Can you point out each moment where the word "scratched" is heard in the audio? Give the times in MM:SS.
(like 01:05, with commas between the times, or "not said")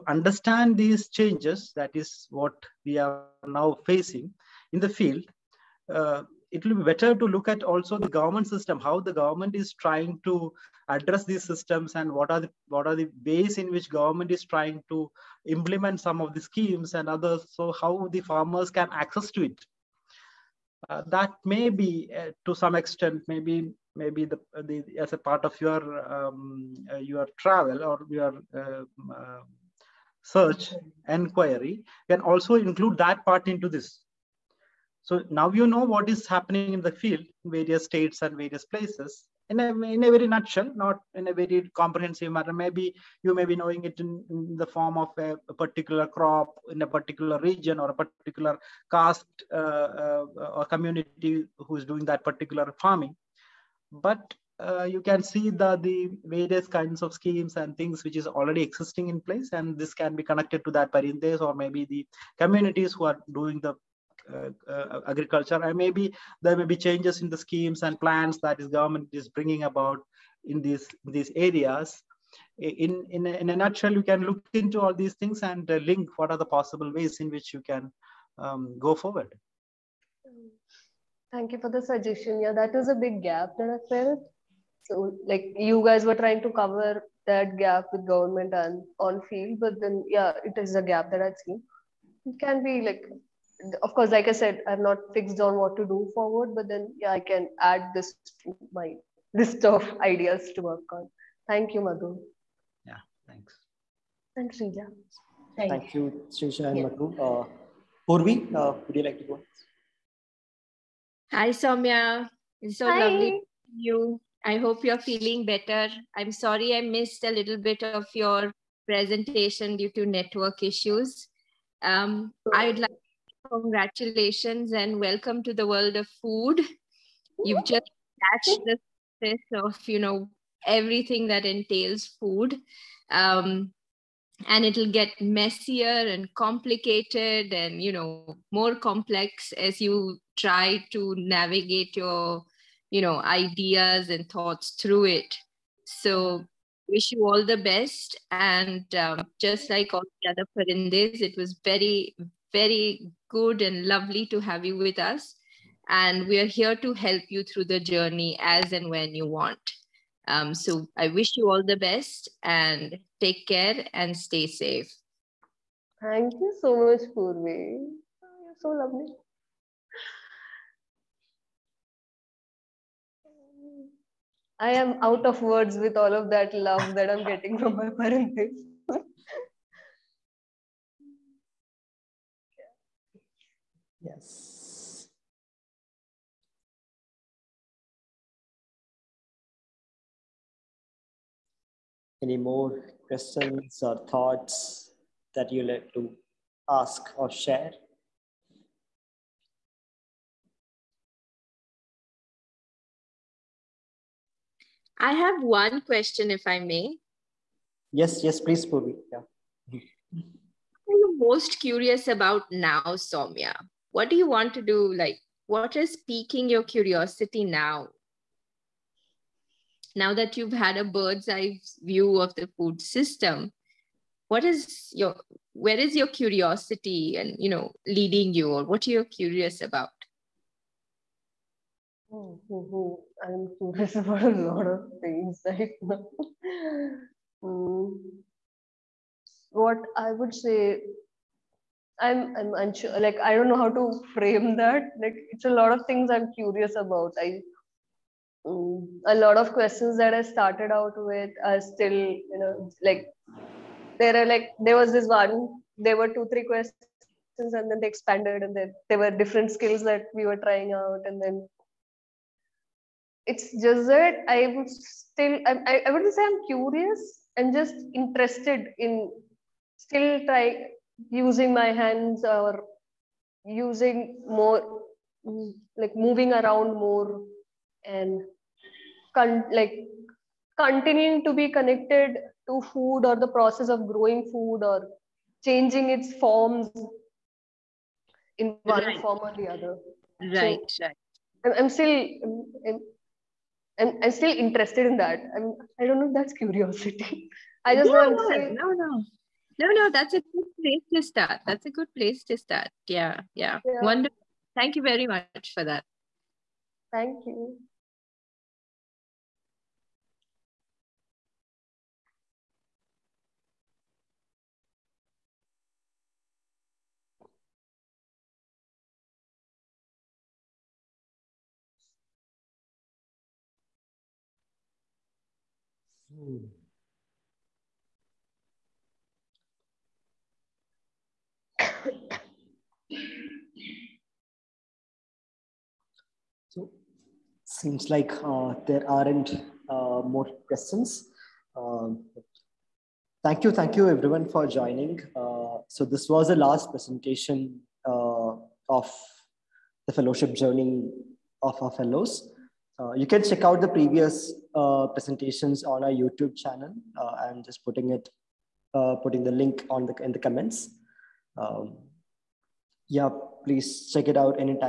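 02:08.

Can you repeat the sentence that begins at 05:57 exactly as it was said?
I'm just putting it, putting the link on the in the comments.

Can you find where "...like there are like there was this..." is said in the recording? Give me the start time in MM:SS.
04:12.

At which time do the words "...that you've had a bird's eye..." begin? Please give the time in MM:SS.
03:40.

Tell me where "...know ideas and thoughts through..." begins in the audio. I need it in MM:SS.
02:22.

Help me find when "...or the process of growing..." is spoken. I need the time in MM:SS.
04:43.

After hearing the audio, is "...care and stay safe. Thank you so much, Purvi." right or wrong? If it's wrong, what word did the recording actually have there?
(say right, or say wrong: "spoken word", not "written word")
right.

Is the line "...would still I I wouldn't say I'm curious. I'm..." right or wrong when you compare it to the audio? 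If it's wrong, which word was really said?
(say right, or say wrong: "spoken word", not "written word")
right.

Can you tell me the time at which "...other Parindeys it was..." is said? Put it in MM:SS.
02:30.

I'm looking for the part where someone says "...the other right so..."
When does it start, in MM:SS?
04:49.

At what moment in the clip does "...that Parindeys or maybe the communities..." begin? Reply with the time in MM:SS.
01:00.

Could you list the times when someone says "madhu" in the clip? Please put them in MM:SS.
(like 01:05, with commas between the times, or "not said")
01:41, 01:46.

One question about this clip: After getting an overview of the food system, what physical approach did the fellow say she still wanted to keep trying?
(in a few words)
using my hands.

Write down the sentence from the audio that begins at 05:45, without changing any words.
Uh, so this was the last presentation uh, of the fellowship journey of our fellows.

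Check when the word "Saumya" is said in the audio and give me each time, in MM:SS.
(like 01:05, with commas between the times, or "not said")
01:51, 03:32.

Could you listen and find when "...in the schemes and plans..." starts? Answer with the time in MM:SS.
01:07.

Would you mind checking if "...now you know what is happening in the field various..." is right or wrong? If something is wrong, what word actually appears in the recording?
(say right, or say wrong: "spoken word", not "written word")
right.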